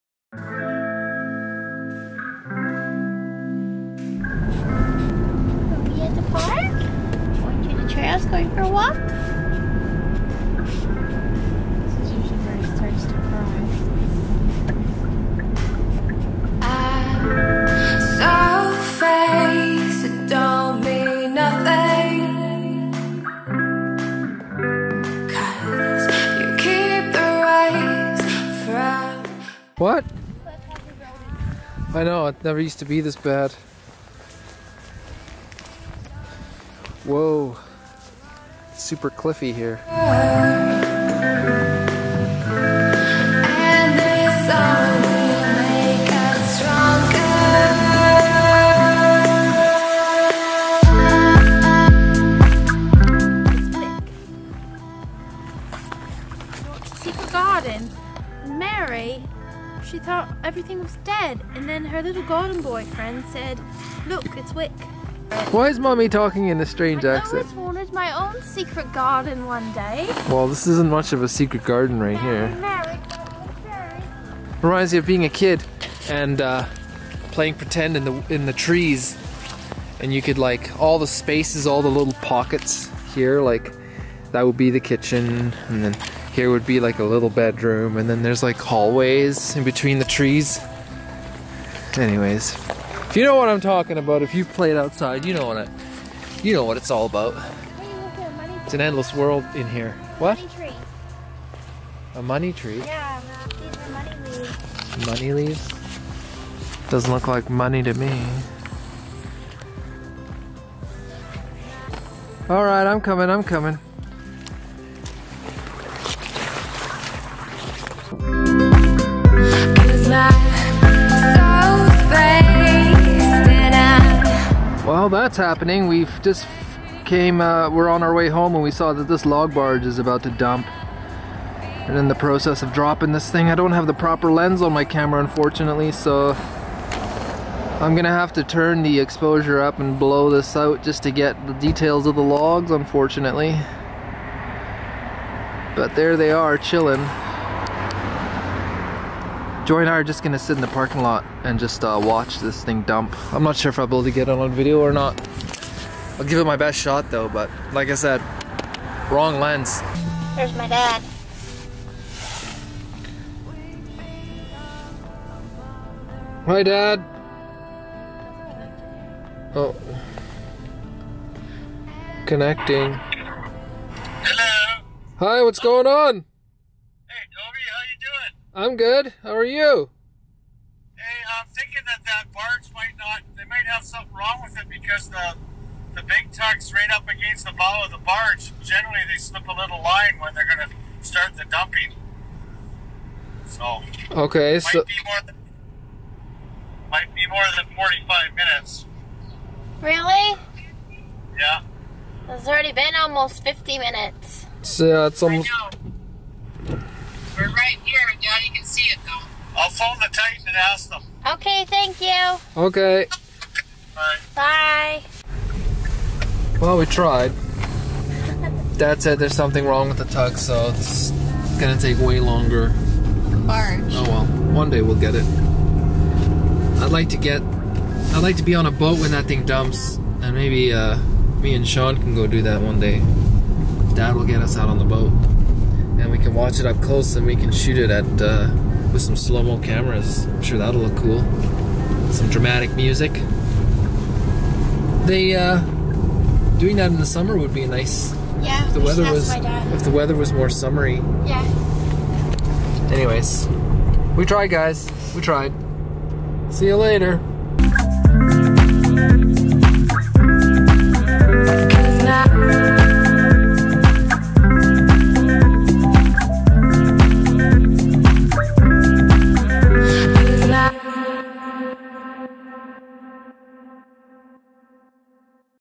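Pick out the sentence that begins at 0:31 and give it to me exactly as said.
I know, it never used to be this bad.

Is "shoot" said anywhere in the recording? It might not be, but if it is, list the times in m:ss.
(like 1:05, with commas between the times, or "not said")
3:57.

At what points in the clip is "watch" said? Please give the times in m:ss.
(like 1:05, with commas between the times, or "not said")
2:32, 3:56.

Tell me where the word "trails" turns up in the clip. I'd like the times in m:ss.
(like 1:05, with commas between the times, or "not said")
0:07.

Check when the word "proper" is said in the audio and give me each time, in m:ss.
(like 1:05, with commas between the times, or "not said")
2:13.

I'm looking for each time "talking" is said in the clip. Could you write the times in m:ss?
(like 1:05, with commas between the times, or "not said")
1:06, 1:33.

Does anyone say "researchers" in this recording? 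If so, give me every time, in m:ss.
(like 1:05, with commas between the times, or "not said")
not said.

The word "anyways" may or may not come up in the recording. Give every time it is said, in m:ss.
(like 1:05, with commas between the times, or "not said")
1:31, 4:12.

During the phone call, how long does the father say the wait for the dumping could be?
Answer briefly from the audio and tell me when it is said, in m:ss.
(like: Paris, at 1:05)
45 minutes, at 3:17.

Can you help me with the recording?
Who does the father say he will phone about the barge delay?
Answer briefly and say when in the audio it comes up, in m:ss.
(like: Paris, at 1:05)
the Titan, at 3:29.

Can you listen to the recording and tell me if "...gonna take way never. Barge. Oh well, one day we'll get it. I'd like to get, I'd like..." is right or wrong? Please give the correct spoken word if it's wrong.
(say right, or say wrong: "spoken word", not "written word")
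wrong: "longer", not "never".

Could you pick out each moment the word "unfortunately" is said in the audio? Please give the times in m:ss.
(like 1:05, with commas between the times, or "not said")
2:15, 2:22.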